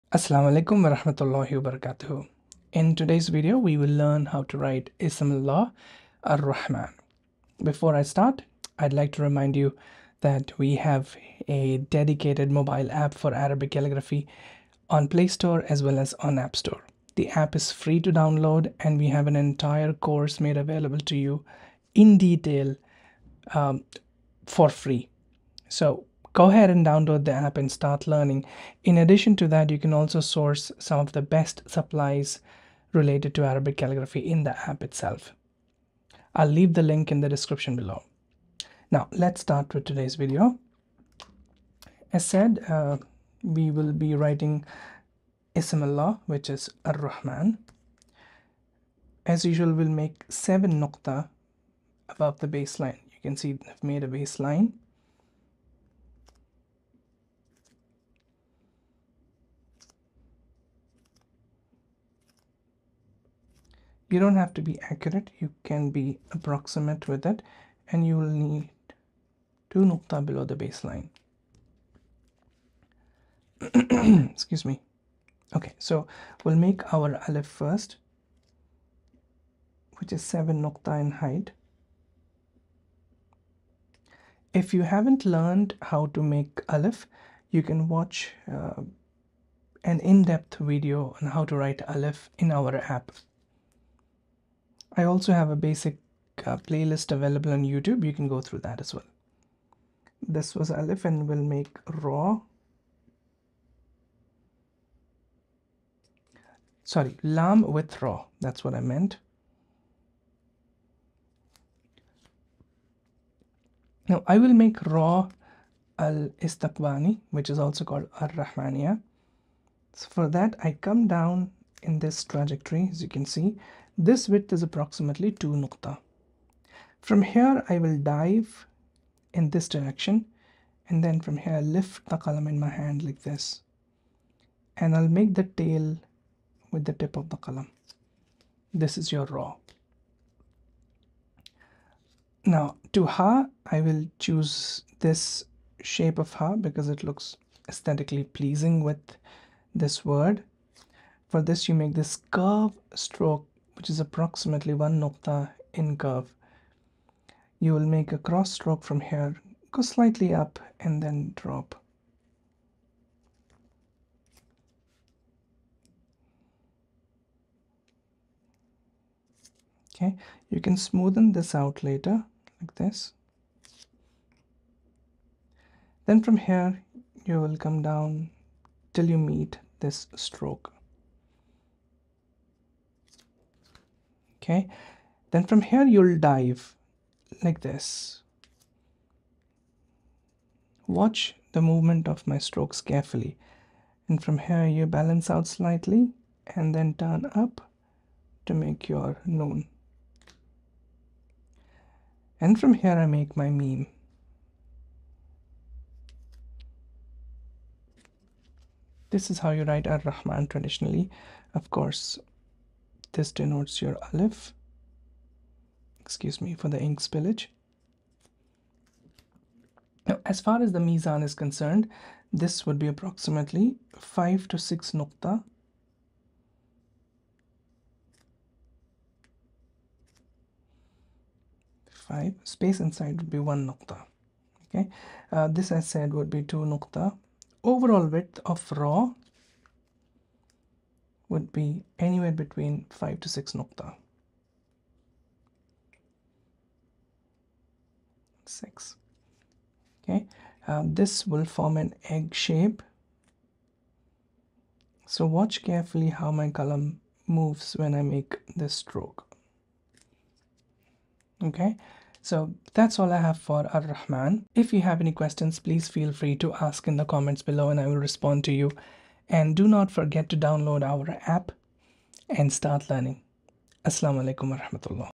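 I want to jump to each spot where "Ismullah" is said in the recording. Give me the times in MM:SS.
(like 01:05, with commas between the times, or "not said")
00:04, 00:45.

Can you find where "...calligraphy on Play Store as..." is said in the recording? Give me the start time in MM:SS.
00:13.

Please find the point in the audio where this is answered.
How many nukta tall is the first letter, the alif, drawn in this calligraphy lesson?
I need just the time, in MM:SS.
01:20.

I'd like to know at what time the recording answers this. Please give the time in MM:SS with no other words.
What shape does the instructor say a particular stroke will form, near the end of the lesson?
04:12.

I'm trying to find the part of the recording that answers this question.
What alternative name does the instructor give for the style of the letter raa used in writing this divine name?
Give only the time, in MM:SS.
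01:58.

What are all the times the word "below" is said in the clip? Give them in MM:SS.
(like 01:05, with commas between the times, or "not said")
00:37, 01:10, 04:27.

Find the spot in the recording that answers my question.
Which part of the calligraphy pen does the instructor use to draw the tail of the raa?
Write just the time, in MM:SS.
02:16.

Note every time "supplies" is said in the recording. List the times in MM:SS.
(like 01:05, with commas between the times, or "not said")
00:31.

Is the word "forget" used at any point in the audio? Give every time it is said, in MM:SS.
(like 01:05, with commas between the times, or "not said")
04:29.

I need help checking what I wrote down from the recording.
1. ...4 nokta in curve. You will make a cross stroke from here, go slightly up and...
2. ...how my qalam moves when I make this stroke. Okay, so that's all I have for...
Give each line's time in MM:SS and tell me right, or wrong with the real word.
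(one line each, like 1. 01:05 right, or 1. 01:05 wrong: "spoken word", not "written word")
1. 02:34 wrong: "1", not "4"
2. 04:16 right.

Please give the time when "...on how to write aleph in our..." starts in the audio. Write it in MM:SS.
01:31.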